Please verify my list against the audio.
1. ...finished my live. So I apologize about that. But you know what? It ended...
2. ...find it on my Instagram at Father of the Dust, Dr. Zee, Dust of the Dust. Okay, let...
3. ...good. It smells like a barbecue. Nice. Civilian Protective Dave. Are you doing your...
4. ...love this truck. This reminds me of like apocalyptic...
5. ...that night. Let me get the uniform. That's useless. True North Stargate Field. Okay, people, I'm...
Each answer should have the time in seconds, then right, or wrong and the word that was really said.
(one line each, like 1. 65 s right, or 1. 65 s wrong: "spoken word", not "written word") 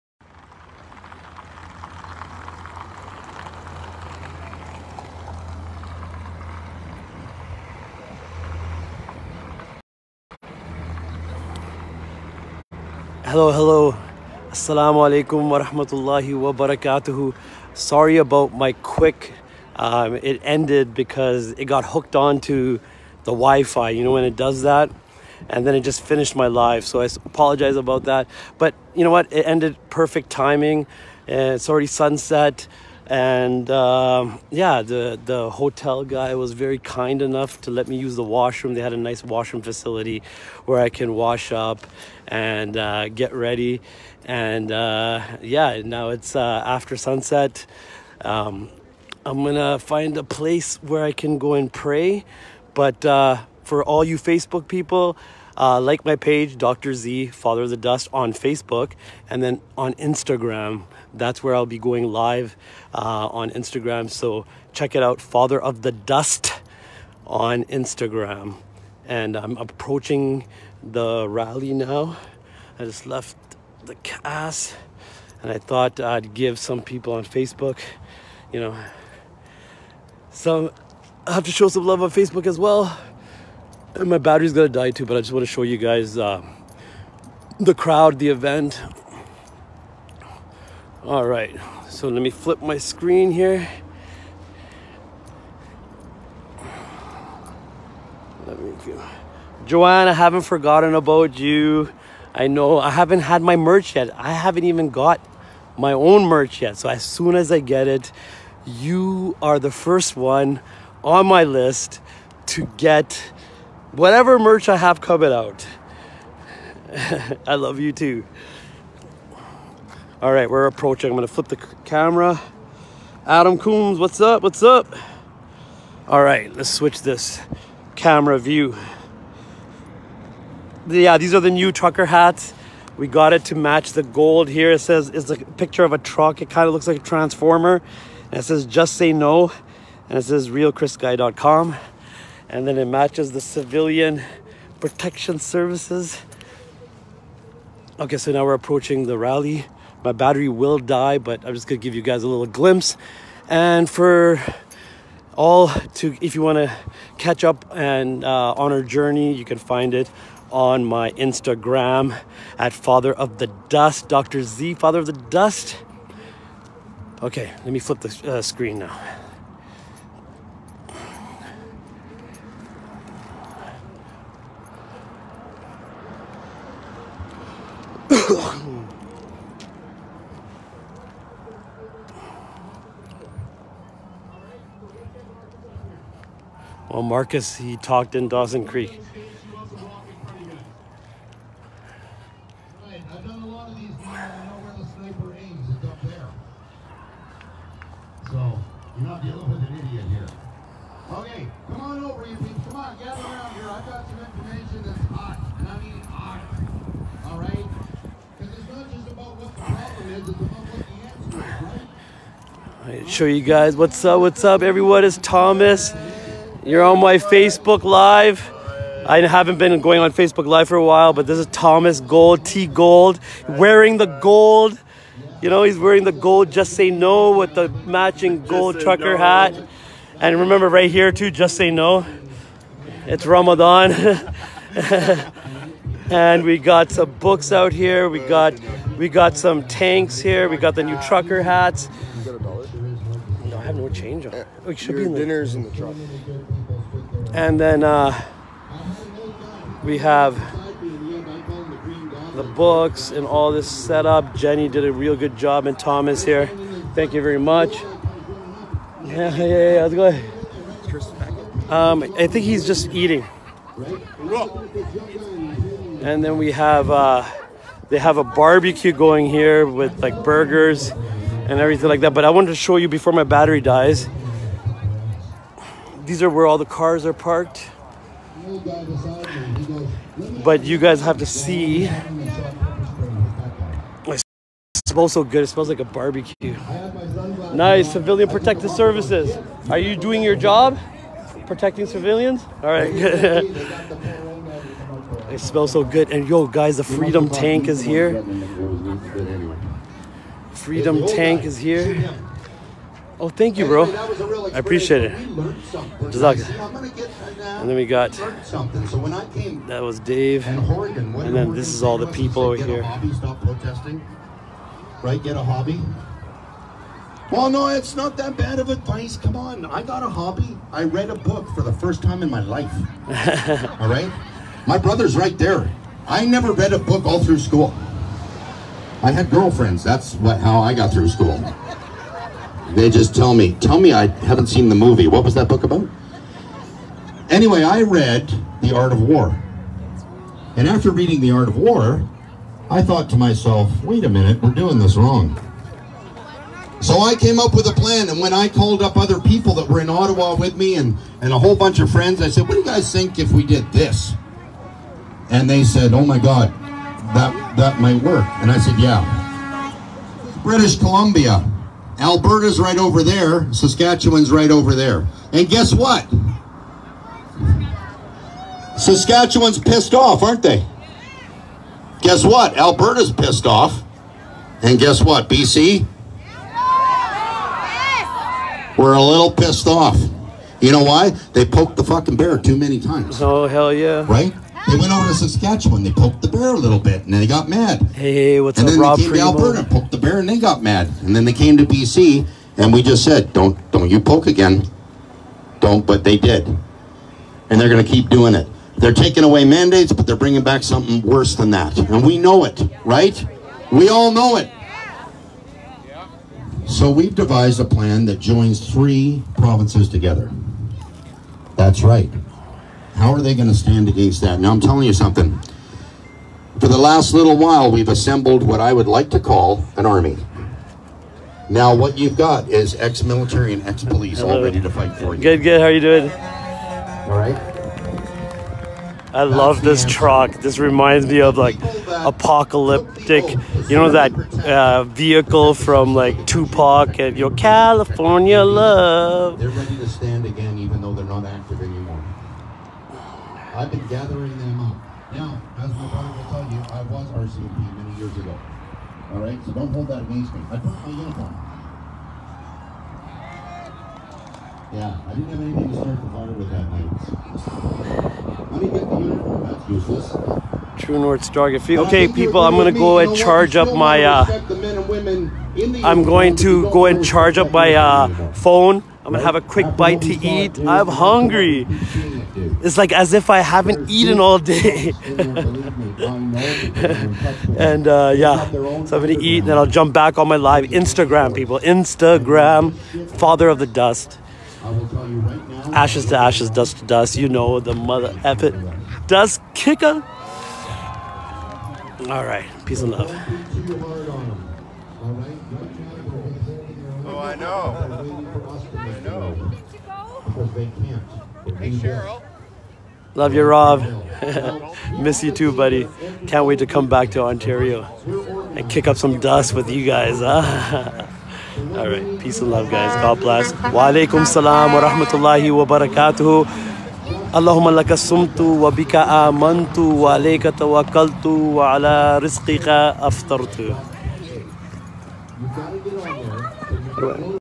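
1. 26 s right
2. 159 s wrong: "Father", not "Dust"
3. 285 s wrong: "Services", not "Dave"
4. 429 s right
5. 456 s right.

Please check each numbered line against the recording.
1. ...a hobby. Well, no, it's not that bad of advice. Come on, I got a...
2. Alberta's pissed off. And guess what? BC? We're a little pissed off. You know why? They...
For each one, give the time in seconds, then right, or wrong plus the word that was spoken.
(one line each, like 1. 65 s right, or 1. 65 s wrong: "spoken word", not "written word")
1. 315 s right
2. 372 s right.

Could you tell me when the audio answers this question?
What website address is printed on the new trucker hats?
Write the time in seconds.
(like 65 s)
140 s.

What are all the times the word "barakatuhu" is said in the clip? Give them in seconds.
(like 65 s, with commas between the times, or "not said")
16 s, 515 s.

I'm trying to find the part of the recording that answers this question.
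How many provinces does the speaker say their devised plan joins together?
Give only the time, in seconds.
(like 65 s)
408 s.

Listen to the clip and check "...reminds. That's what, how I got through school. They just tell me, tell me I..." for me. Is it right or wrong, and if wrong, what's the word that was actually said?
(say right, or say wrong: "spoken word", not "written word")
wrong: "girlfriends", not "reminds".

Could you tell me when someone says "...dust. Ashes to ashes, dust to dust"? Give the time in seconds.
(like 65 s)
483 s.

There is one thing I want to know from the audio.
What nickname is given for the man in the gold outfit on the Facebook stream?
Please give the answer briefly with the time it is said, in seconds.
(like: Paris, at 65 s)
T Gold, at 222 s.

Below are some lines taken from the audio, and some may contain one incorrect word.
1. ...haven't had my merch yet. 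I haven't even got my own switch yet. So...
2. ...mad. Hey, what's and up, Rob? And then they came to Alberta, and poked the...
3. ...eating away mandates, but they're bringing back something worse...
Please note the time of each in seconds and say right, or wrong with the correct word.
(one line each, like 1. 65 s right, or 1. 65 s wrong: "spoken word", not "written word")
1. 102 s wrong: "merch", not "switch"
2. 387 s right
3. 398 s wrong: "taking", not "eating".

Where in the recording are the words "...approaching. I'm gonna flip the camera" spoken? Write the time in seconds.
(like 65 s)
120 s.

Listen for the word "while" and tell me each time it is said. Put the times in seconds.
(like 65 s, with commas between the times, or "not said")
220 s, 417 s.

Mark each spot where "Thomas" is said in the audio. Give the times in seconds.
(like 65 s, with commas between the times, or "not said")
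221 s, 255 s.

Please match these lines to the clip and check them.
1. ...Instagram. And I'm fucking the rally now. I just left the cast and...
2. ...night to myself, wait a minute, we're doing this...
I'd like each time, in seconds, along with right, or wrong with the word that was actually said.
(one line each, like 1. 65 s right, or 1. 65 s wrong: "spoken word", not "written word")
1. 67 s wrong: "approaching", not "fucking"
2. 342 s wrong: "thought", not "night".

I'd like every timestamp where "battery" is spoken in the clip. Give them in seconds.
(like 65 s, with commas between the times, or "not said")
84 s, 150 s, 273 s.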